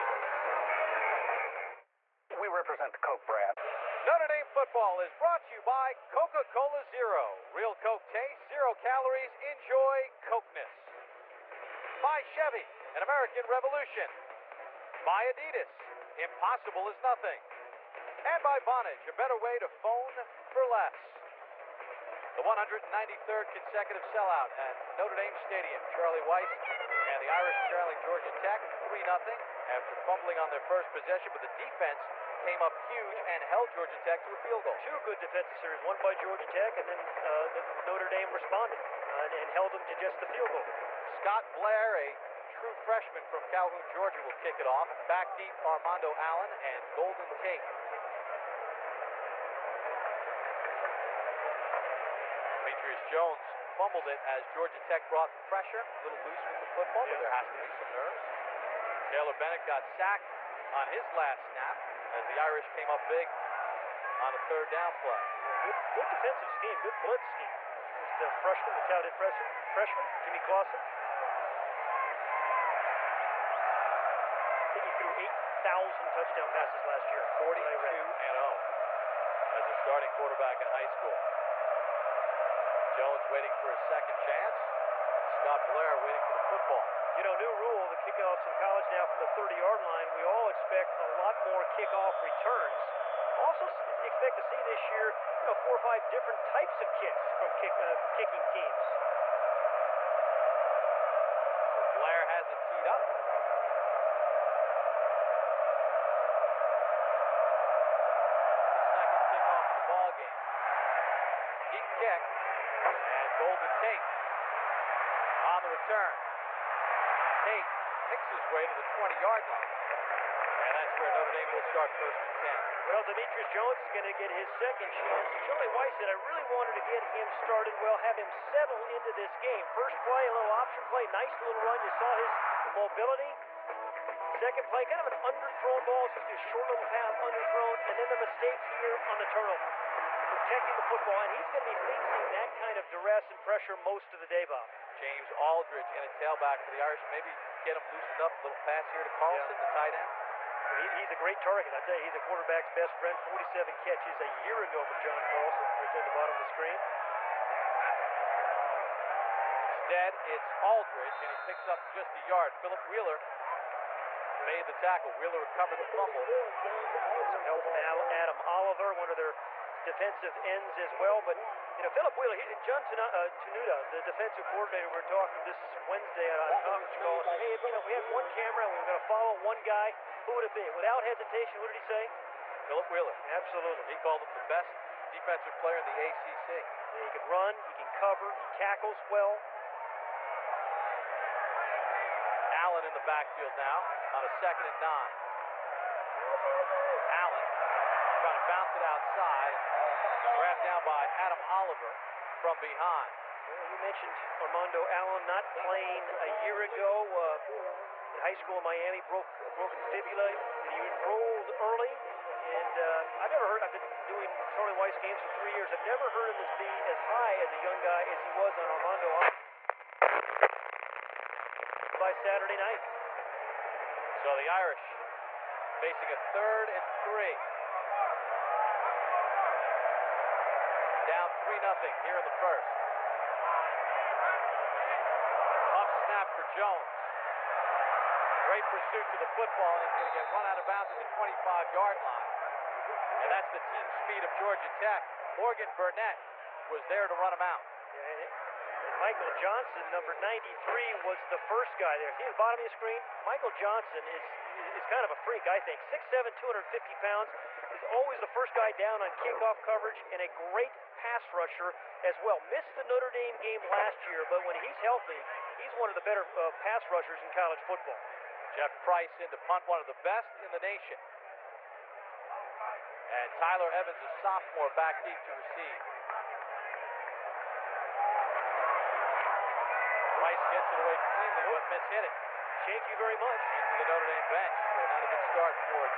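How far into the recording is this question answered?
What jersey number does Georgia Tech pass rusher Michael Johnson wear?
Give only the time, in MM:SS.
04:10.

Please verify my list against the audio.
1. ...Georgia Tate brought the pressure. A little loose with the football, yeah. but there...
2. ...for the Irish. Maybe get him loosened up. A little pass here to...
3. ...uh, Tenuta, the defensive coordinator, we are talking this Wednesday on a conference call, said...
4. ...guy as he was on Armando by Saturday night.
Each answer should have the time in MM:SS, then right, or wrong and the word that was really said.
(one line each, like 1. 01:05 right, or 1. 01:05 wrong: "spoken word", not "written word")
1. 00:54 wrong: "Tech", not "Tate"
2. 02:26 right
3. 02:53 right
4. 03:37 right.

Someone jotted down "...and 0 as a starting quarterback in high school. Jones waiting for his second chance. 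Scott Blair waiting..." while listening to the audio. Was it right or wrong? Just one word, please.
right.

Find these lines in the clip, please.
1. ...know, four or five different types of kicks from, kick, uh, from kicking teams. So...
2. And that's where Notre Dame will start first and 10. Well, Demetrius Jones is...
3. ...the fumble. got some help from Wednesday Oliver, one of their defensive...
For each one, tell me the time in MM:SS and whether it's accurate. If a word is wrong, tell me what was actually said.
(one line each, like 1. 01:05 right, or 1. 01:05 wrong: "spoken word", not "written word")
1. 01:35 right
2. 02:00 right
3. 02:45 wrong: "Adam", not "Wednesday".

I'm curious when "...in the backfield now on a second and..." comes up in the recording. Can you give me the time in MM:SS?
03:12.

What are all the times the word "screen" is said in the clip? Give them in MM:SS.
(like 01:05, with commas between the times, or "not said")
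02:36, 04:12.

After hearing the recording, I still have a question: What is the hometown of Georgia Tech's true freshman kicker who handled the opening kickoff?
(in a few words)
Calhoun, Georgia.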